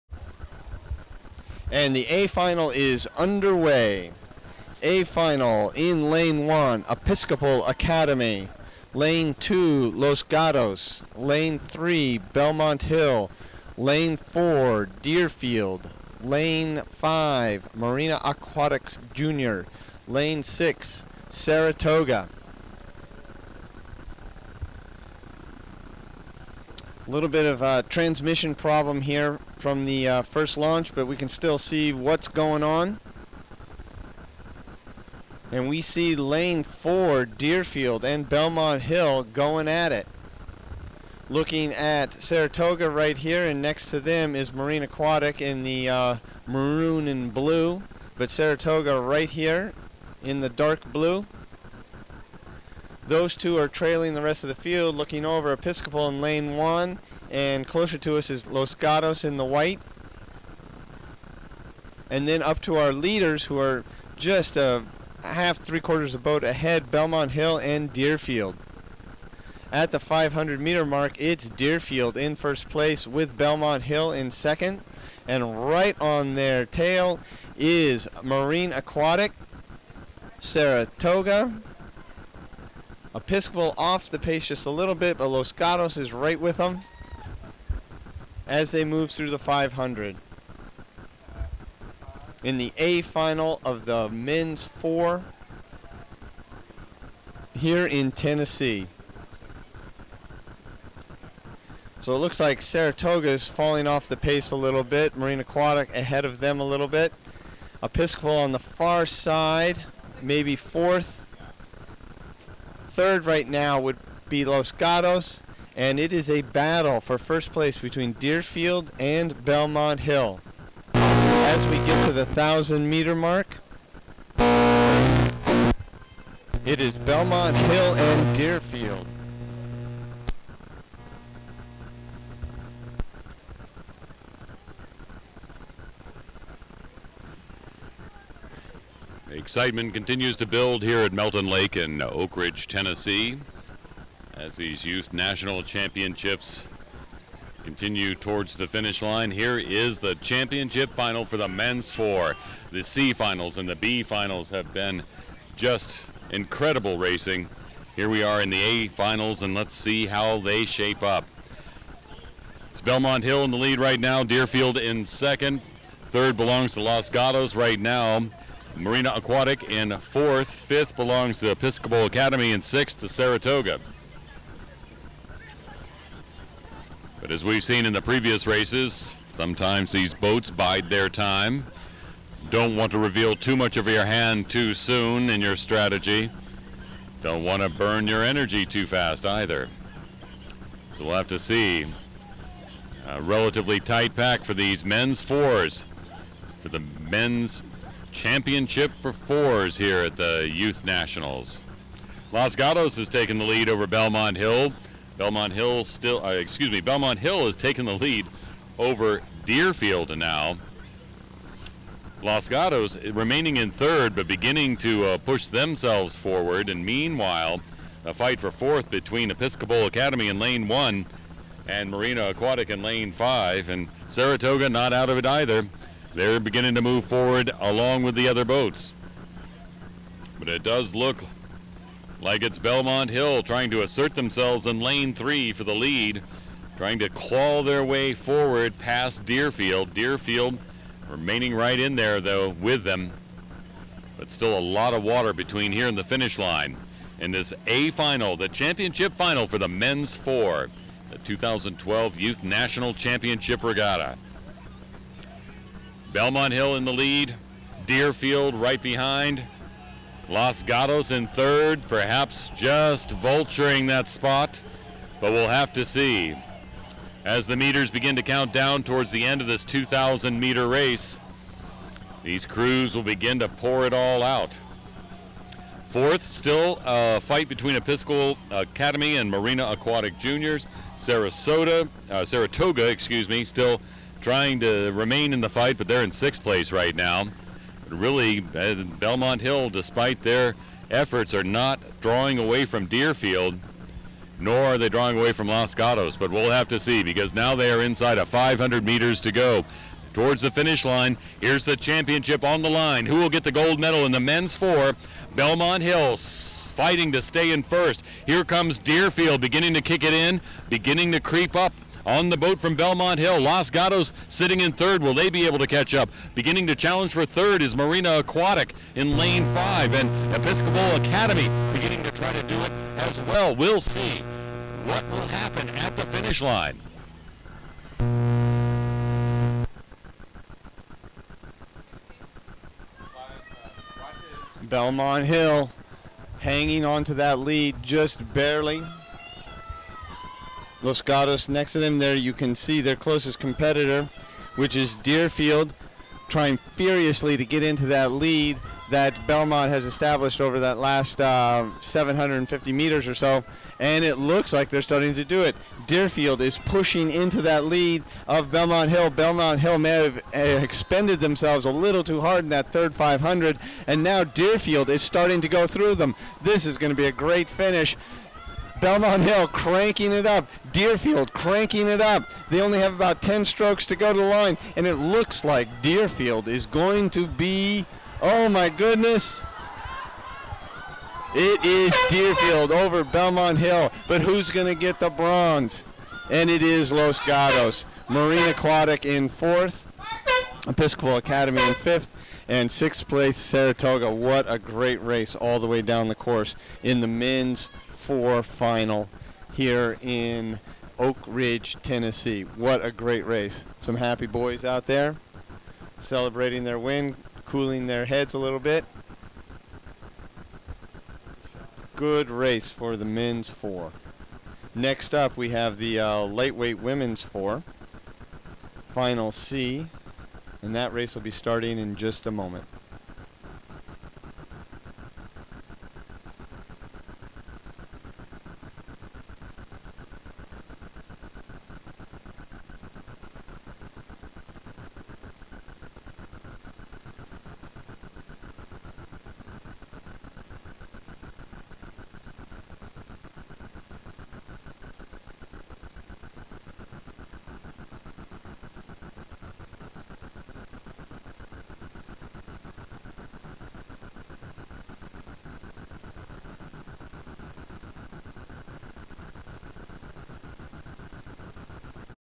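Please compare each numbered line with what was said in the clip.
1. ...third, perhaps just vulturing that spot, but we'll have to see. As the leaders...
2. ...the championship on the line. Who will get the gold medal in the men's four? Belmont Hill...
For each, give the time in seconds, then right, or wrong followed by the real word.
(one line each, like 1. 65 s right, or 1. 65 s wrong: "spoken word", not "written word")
1. 261 s wrong: "meters", not "leaders"
2. 301 s right.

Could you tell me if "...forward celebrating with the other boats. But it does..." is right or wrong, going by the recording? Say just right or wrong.
wrong.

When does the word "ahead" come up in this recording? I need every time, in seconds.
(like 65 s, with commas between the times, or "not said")
66 s, 105 s.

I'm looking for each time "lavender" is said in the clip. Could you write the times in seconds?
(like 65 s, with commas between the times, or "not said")
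not said.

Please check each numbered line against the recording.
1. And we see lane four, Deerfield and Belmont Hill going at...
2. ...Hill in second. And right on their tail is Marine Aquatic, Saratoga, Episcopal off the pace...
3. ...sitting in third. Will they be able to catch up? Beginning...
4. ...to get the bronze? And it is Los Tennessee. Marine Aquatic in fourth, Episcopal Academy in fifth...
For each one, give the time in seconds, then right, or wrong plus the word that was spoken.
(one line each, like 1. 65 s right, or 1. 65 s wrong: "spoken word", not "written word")
1. 35 s right
2. 73 s right
3. 314 s right
4. 384 s wrong: "Gatos", not "Tennessee".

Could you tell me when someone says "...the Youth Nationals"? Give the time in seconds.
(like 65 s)
200 s.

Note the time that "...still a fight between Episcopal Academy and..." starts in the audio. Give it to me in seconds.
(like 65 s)
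276 s.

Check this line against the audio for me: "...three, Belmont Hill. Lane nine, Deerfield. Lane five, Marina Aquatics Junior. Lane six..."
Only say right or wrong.
wrong.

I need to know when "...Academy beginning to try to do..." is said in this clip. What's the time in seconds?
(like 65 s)
320 s.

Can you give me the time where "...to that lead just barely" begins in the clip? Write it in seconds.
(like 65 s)
337 s.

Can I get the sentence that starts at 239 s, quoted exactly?
Deerfield remaining right in there, though, with them.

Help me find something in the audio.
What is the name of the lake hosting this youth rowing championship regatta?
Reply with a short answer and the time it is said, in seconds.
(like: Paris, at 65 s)
Melton Lake, at 141 s.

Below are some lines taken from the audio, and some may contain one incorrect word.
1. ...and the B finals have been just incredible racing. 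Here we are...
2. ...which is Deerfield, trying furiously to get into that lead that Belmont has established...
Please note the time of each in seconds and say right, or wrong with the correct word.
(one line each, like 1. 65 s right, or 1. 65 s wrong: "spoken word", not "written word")
1. 153 s right
2. 344 s right.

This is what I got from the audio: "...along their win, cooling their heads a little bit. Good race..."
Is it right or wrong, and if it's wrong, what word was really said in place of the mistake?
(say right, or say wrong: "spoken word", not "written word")
wrong: "celebrating", not "along".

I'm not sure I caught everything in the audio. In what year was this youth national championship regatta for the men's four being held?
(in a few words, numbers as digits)
2012.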